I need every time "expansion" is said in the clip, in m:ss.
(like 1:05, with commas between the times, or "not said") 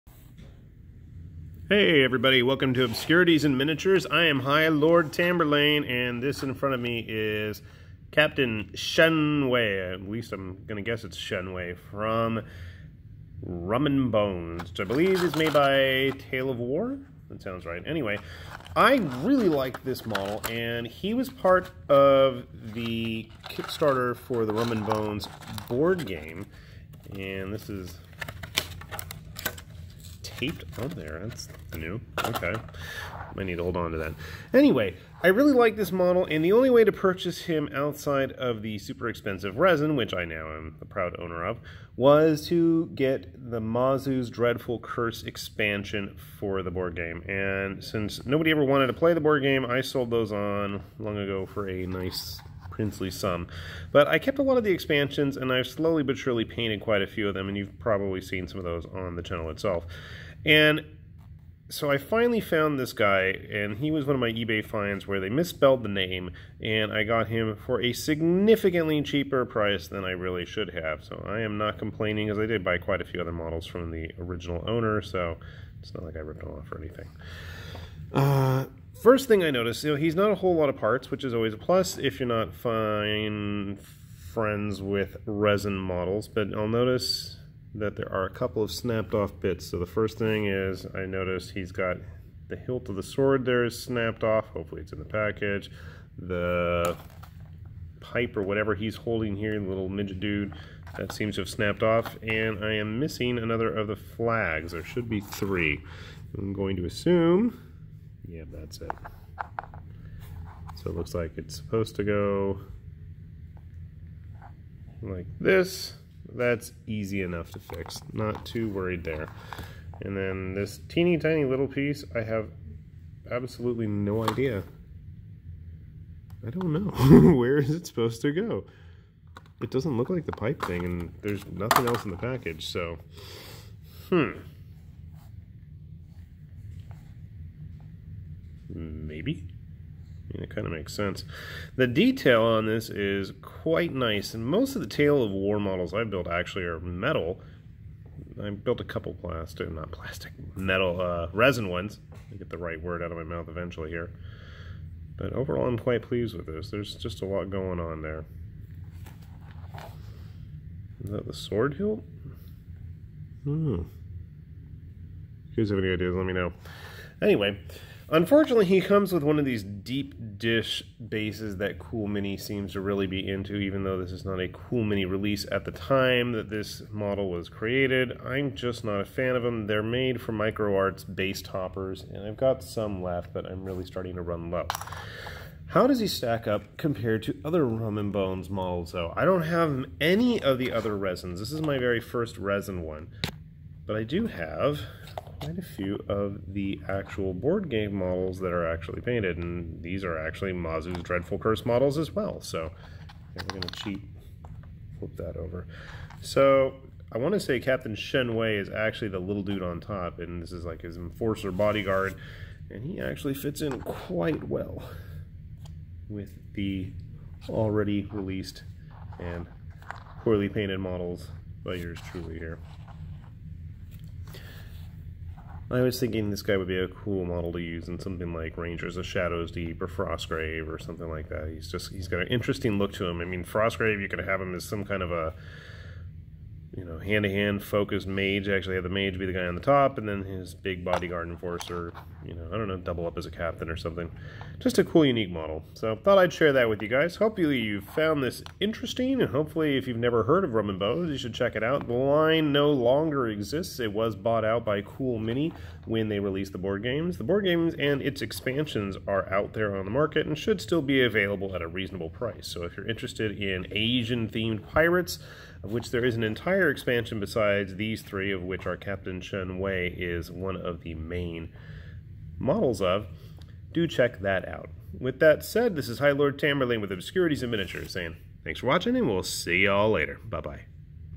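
0:45, 0:54, 4:18, 4:26.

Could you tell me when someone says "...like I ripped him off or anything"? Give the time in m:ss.
1:16.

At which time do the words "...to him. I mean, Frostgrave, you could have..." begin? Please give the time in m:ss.
3:52.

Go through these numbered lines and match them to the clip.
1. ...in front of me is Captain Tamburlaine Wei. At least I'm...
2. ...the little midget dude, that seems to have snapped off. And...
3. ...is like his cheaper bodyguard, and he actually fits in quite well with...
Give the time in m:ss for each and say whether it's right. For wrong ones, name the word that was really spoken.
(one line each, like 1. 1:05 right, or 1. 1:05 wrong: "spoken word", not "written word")
1. 0:06 wrong: "Shen", not "Tamburlaine"
2. 1:39 right
3. 3:30 wrong: "enforcer", not "cheaper".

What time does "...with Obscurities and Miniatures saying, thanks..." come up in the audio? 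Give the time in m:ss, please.
4:36.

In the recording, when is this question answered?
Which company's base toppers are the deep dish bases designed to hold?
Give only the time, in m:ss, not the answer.
3:00.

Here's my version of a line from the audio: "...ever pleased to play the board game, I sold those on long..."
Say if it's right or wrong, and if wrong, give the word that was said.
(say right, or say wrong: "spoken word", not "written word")
wrong: "wanted", not "pleased".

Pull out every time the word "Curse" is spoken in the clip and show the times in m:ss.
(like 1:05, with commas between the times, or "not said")
0:44, 3:21.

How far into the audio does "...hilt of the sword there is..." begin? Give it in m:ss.
1:32.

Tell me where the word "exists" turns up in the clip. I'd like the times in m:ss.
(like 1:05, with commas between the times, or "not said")
4:13.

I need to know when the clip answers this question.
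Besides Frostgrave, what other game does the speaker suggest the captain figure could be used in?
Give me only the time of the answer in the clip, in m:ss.
3:48.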